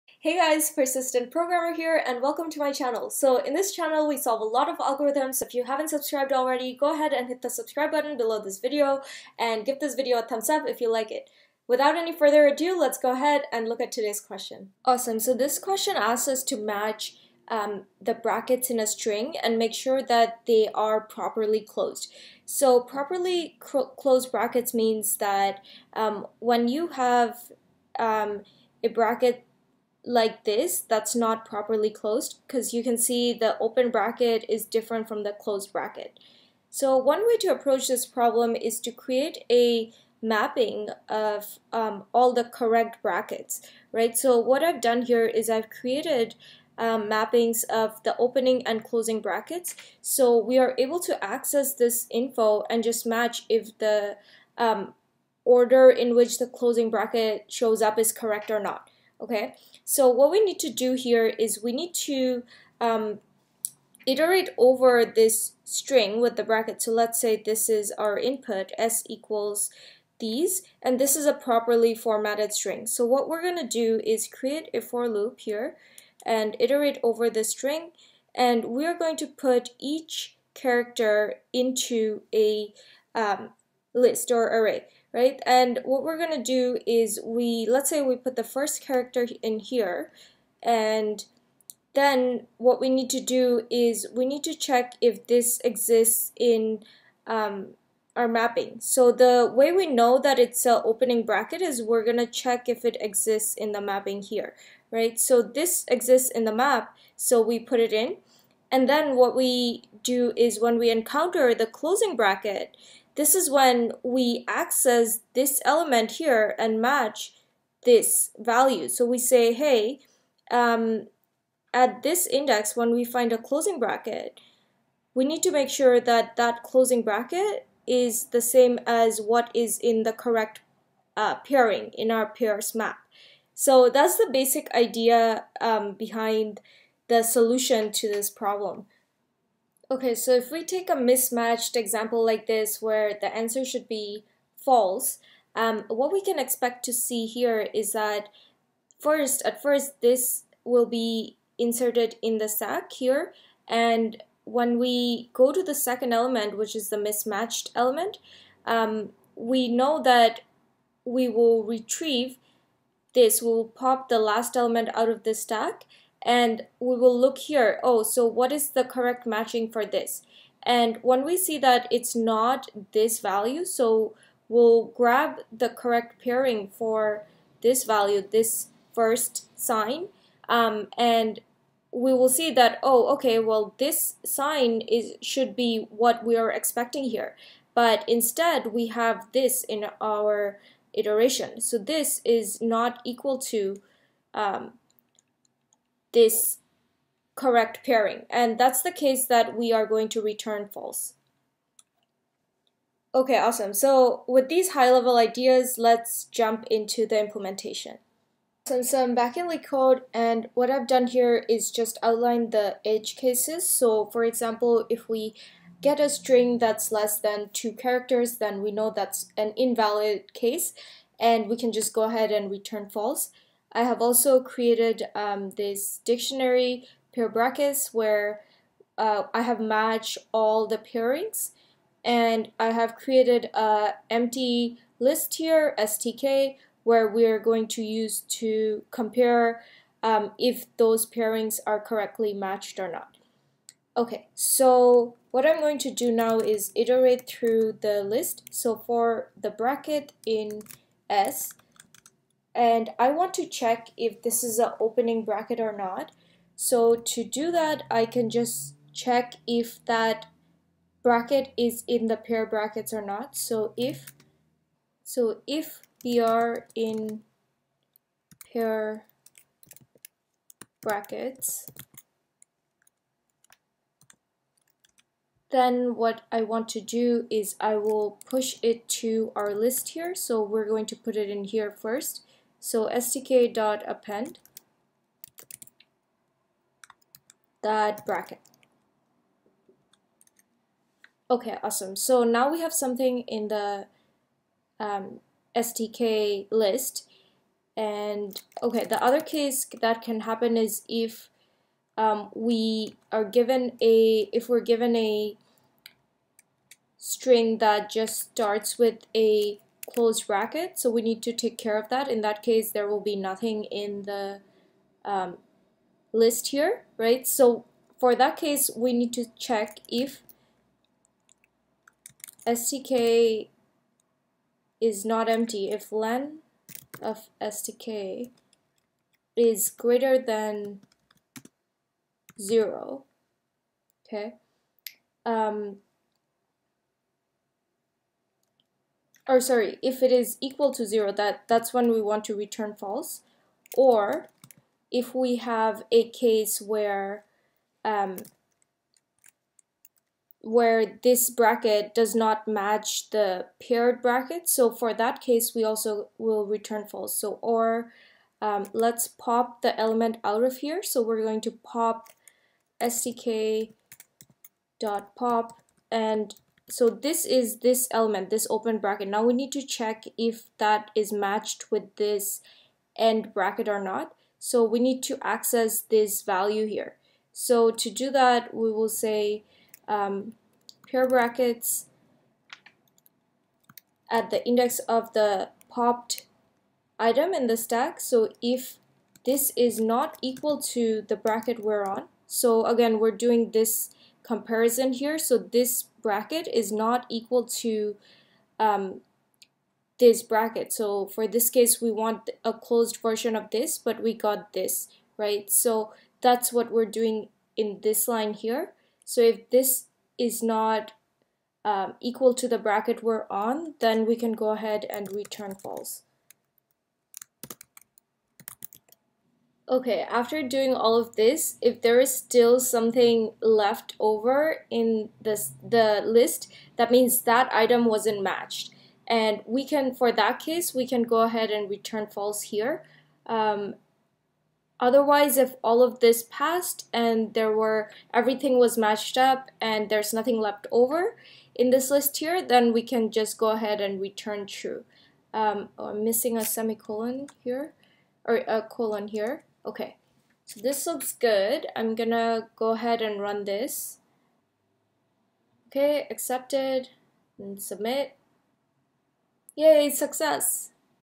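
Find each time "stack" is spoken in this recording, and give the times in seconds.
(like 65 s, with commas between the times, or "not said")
152 s, 165 s, 387 s.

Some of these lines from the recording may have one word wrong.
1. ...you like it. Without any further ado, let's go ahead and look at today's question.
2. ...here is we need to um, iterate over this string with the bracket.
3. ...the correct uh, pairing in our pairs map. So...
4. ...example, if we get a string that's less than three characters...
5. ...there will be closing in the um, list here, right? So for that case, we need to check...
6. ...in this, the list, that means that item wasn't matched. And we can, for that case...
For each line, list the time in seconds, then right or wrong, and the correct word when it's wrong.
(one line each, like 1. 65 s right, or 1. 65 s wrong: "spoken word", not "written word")
1. 10 s right
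2. 60 s right
3. 130 s right
4. 214 s wrong: "two", not "three"
5. 312 s wrong: "nothing", not "closing"
6. 424 s right.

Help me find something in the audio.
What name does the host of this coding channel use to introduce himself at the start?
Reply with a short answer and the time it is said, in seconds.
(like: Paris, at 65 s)
Persistent Programmer, at 0 s.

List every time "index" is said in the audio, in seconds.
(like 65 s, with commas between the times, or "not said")
122 s, 384 s.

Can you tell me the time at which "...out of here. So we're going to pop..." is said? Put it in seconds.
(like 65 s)
360 s.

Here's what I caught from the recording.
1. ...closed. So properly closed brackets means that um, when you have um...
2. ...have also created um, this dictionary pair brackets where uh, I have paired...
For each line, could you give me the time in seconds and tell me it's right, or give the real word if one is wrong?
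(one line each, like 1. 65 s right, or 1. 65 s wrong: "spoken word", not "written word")
1. 21 s right
2. 223 s wrong: "matched", not "paired".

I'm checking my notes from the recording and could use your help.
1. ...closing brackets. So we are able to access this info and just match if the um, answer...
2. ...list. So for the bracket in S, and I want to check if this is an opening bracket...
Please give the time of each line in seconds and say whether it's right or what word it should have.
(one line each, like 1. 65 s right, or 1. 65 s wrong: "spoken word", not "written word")
1. 48 s wrong: "order", not "answer"
2. 248 s right.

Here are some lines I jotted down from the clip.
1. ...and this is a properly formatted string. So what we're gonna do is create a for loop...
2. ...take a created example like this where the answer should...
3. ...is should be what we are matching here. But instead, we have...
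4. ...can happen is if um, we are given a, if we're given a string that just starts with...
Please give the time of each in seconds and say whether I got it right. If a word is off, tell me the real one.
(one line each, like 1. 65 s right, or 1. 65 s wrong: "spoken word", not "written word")
1. 70 s right
2. 140 s wrong: "mismatched", not "created"
3. 184 s wrong: "expecting", not "matching"
4. 300 s right.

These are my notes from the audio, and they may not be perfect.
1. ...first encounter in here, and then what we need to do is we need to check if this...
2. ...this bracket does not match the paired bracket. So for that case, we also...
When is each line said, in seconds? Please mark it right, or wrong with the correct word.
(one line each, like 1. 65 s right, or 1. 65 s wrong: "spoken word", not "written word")
1. 88 s wrong: "character", not "encounter"
2. 351 s right.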